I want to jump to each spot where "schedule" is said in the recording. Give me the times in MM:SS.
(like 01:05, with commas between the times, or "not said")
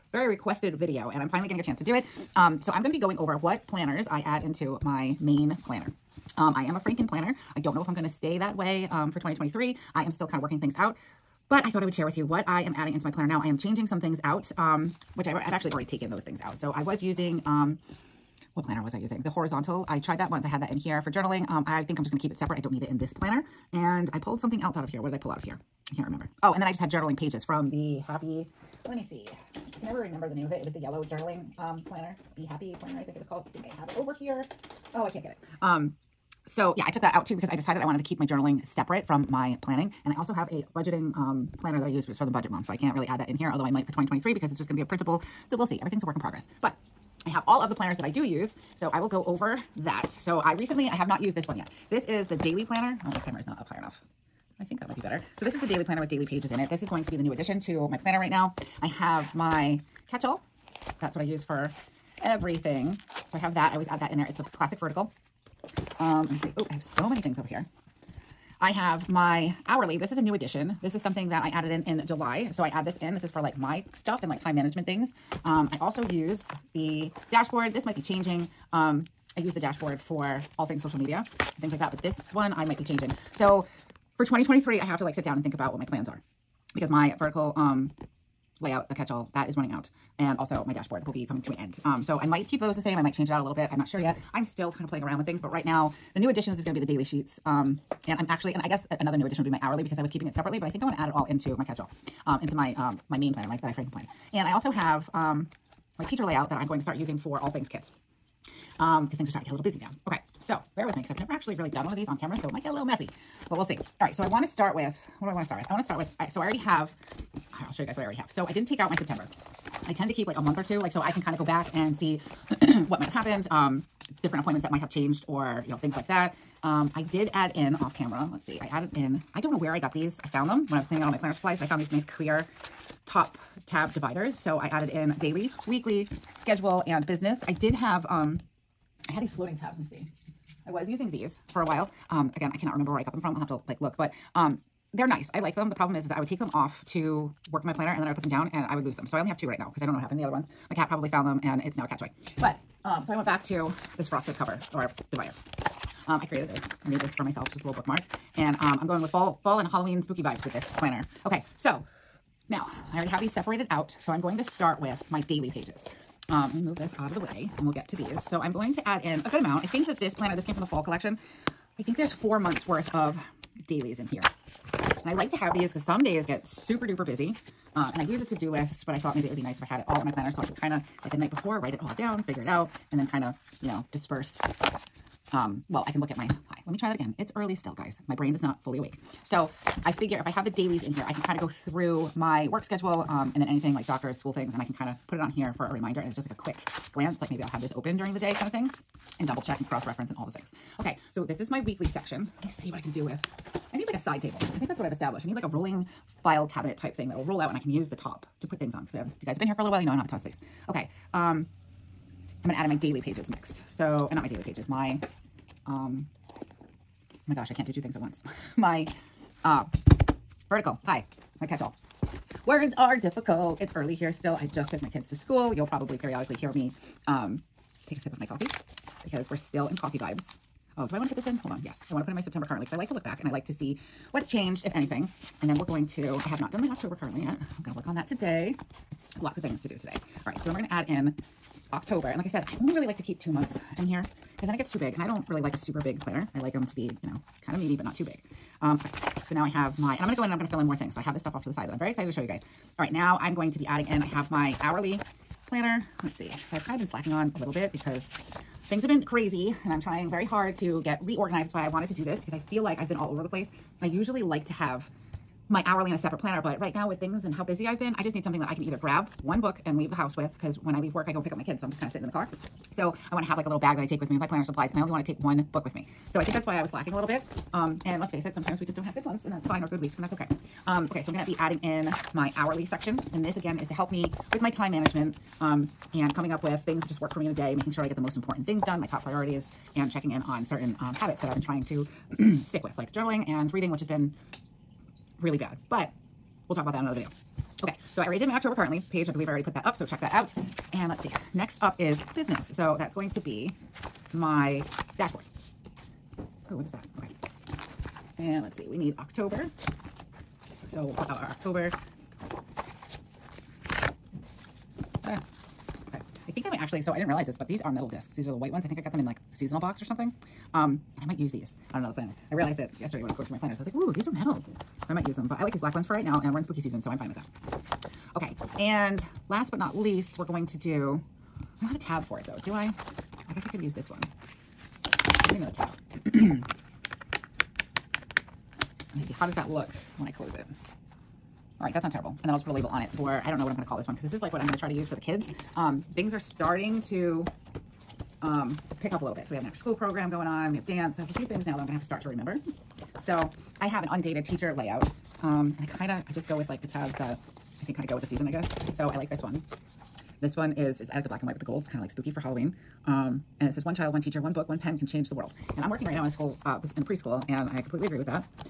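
02:16, 03:12.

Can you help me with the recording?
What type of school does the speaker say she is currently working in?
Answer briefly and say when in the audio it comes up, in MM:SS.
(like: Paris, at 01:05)
preschool, at 06:06.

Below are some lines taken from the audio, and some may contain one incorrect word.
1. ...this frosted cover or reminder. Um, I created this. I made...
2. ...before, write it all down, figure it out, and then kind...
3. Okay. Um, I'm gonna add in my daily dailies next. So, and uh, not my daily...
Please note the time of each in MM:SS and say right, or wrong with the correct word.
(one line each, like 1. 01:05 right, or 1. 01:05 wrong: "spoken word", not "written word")
1. 02:33 wrong: "divider", not "reminder"
2. 03:01 right
3. 03:30 wrong: "pages", not "dailies".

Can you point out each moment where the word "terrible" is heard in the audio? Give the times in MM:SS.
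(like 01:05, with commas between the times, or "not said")
05:41.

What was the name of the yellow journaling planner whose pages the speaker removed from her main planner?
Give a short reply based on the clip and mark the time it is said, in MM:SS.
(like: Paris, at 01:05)
Be Happy planner, at 00:32.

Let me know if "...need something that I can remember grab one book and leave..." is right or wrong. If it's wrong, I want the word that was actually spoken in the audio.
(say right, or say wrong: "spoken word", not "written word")
wrong: "either", not "remember".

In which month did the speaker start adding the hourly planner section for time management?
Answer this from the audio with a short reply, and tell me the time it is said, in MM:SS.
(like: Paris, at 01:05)
July, at 01:12.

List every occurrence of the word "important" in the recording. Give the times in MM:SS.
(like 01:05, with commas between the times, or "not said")
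04:48.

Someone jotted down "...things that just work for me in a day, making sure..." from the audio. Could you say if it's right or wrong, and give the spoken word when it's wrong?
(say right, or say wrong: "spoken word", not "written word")
right.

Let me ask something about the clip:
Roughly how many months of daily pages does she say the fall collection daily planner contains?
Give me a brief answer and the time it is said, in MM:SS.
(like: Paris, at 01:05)
4, at 02:52.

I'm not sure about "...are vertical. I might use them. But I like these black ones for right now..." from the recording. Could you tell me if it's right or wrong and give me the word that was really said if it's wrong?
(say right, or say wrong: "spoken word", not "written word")
wrong: "metal", not "vertical".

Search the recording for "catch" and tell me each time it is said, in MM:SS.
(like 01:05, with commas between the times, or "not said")
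01:00, 01:28, 01:41, 03:41.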